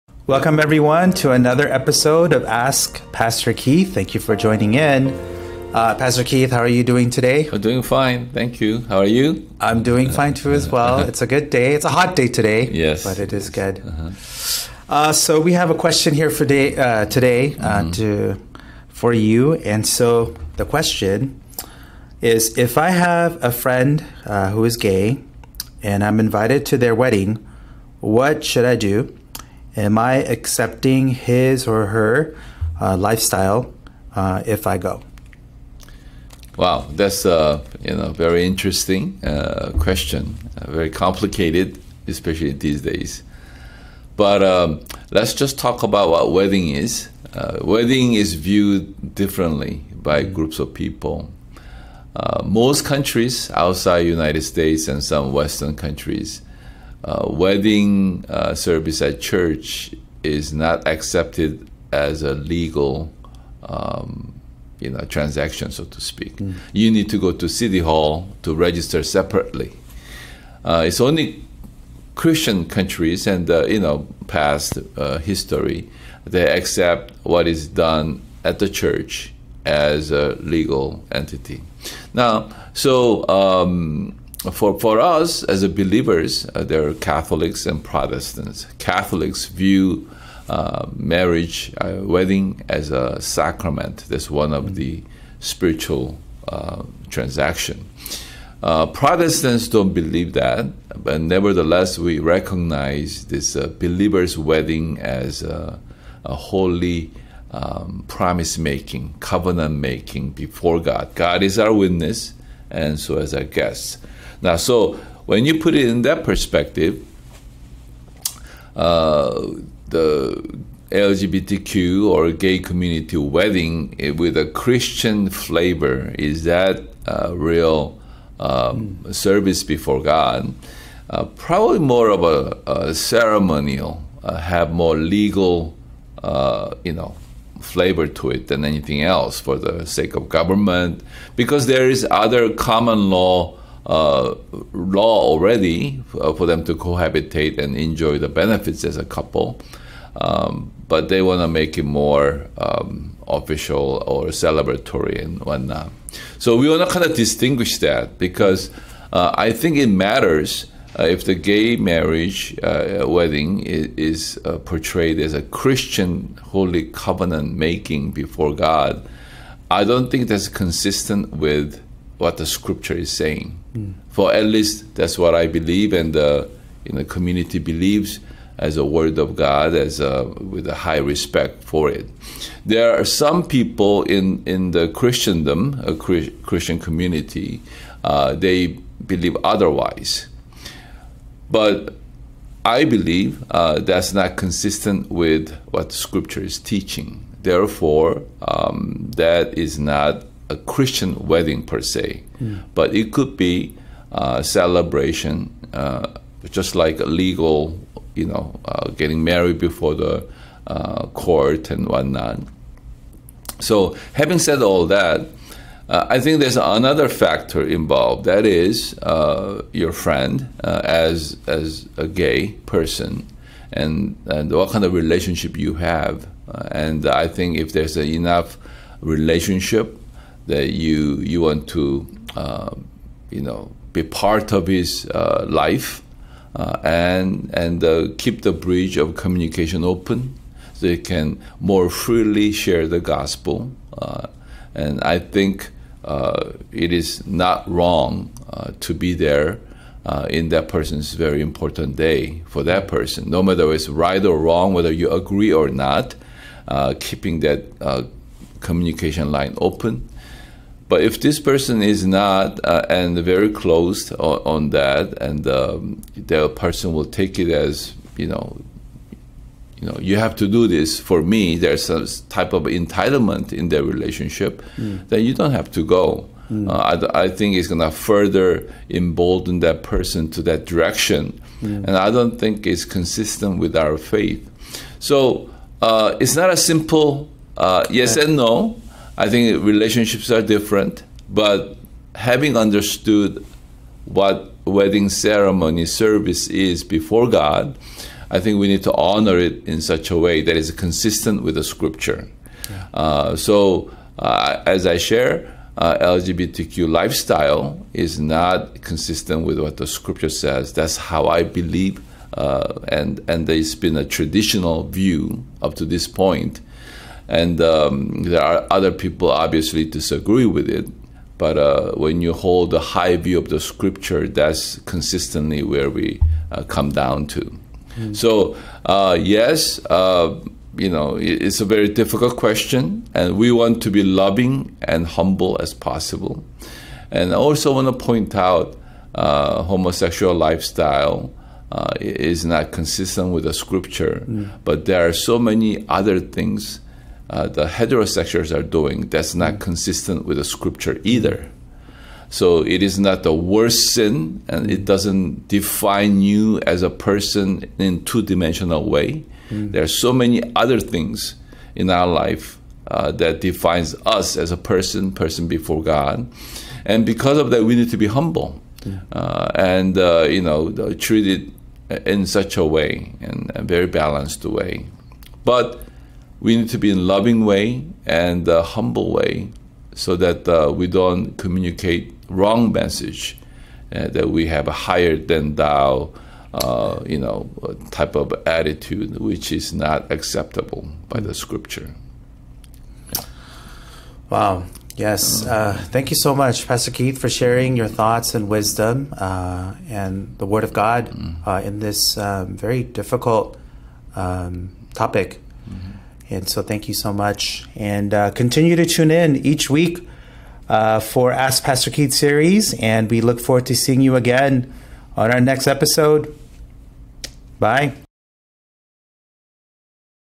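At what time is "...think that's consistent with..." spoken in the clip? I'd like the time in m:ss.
2:50.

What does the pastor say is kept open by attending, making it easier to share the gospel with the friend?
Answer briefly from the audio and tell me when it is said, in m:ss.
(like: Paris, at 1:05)
Bridge of communication, at 3:58.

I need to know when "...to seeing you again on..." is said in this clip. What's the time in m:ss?
6:53.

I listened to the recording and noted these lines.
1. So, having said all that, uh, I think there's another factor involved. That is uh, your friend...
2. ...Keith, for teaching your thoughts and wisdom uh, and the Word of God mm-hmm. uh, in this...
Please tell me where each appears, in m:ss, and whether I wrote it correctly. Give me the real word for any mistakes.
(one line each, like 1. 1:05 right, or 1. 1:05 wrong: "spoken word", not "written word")
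1. 3:33 right
2. 6:36 wrong: "sharing", not "teaching".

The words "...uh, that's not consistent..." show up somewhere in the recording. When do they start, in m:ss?
3:13.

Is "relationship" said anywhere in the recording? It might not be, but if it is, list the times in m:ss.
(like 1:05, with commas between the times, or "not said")
3:44, 3:49, 4:33, 4:49.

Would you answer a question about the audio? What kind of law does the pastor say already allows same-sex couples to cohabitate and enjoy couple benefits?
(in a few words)
Common law.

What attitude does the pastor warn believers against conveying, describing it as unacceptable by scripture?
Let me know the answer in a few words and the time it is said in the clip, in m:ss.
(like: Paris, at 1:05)
Higher than thou, at 6:24.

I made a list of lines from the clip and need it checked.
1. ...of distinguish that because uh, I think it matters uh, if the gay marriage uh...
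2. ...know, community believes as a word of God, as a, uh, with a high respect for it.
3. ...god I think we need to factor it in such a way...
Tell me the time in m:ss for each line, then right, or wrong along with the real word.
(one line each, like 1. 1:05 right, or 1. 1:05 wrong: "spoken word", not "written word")
1. 2:37 right
2. 2:56 right
3. 4:57 wrong: "honor", not "factor".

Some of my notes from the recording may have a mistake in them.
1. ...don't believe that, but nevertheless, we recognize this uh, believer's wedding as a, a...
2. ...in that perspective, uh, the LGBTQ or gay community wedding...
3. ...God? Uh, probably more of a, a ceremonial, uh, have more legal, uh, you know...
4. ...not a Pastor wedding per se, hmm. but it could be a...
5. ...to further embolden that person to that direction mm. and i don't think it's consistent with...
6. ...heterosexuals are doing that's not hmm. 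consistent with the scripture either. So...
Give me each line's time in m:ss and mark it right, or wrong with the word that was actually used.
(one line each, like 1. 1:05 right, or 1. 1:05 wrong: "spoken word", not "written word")
1. 1:39 right
2. 1:55 right
3. 2:10 right
4. 3:19 wrong: "Christian", not "Pastor"
5. 4:37 right
6. 5:47 right.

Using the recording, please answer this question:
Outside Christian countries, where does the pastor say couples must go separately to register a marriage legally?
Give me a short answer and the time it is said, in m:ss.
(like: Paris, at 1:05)
City hall, at 1:07.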